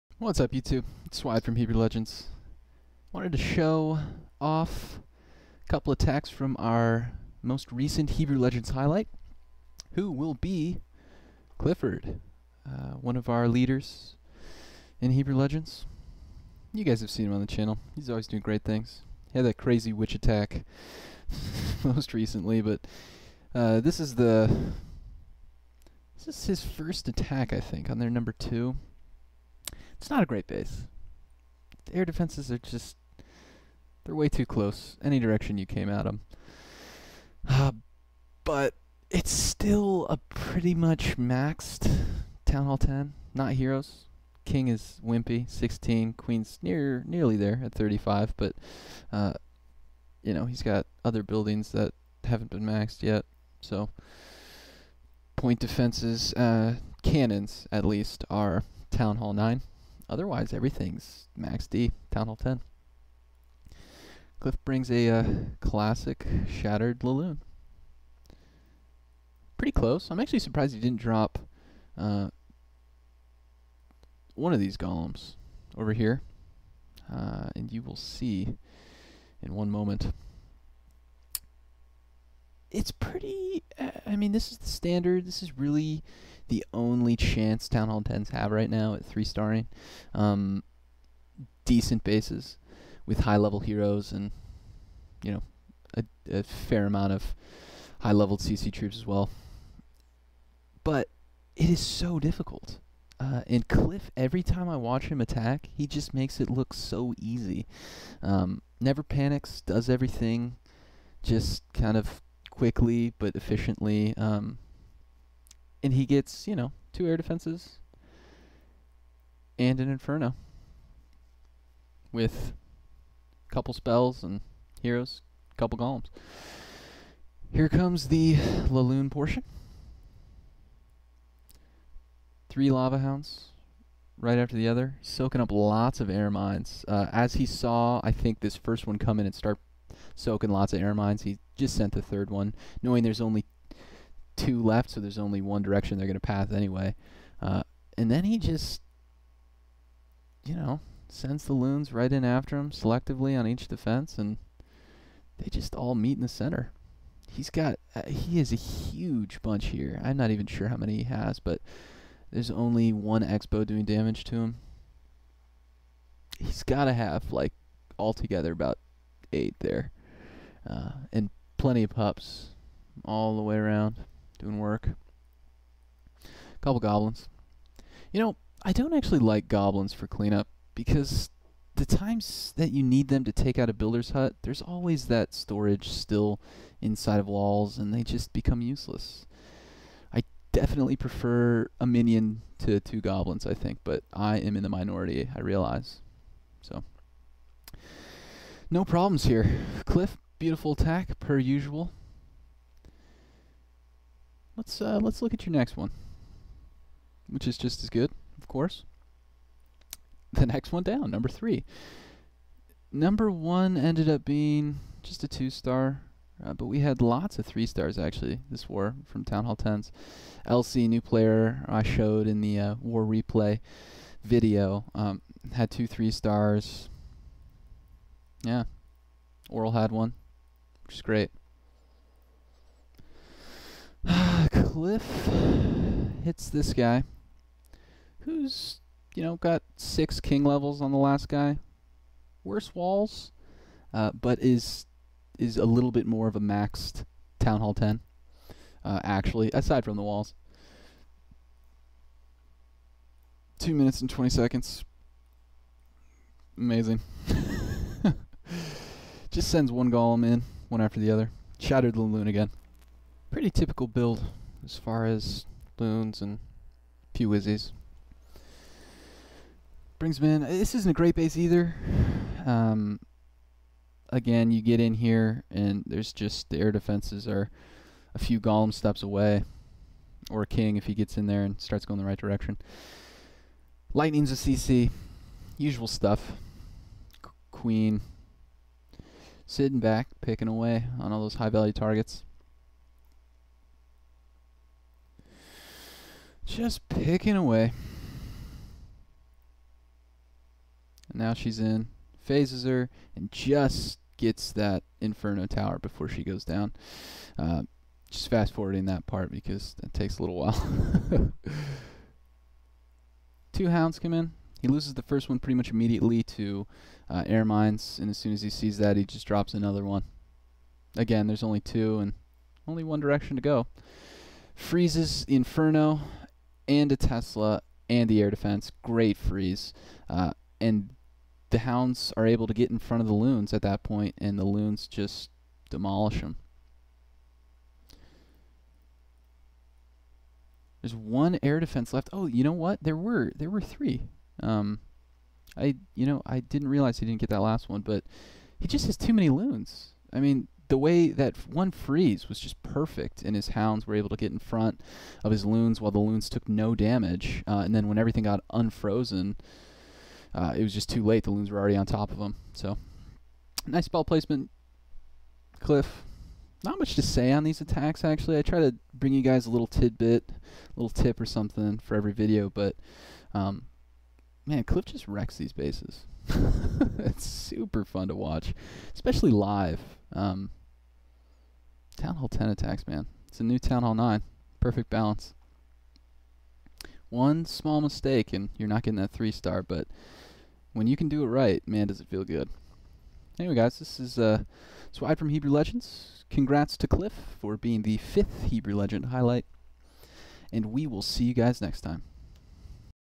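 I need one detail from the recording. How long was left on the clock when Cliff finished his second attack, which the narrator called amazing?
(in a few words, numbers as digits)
2 minutes 20 seconds.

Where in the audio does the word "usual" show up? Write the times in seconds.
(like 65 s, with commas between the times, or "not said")
201 s, 285 s.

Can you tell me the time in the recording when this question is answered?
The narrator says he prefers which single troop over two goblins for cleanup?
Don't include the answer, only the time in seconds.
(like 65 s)
191 s.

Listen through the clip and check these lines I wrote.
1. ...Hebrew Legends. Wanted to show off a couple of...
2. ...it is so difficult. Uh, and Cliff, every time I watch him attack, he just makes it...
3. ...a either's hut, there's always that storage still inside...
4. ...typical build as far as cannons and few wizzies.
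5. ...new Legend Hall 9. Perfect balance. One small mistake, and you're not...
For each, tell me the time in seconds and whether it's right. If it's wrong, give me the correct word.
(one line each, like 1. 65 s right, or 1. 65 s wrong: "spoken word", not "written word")
1. 1 s right
2. 101 s right
3. 183 s wrong: "builder", not "either"
4. 263 s wrong: "loons", not "cannons"
5. 383 s wrong: "Town", not "Legend".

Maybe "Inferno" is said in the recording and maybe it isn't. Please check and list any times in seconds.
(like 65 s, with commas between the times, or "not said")
119 s, 305 s, 325 s.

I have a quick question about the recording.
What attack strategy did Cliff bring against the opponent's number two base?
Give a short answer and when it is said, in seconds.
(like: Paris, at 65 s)
Shattered Laloon, at 66 s.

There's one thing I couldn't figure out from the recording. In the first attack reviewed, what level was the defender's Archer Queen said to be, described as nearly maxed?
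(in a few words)
35.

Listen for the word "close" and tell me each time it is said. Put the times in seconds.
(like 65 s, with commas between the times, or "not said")
34 s, 69 s.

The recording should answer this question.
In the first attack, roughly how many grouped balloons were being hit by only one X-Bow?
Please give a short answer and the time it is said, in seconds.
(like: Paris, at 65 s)
8, at 169 s.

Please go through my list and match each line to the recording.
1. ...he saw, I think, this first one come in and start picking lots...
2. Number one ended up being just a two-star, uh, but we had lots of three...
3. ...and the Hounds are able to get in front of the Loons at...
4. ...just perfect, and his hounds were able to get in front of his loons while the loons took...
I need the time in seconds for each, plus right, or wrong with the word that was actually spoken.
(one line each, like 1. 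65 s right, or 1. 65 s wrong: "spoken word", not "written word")
1. 137 s wrong: "soaking", not "picking"
2. 212 s right
3. 330 s right
4. 352 s right.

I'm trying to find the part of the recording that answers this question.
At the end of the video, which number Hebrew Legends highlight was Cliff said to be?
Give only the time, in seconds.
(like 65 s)
397 s.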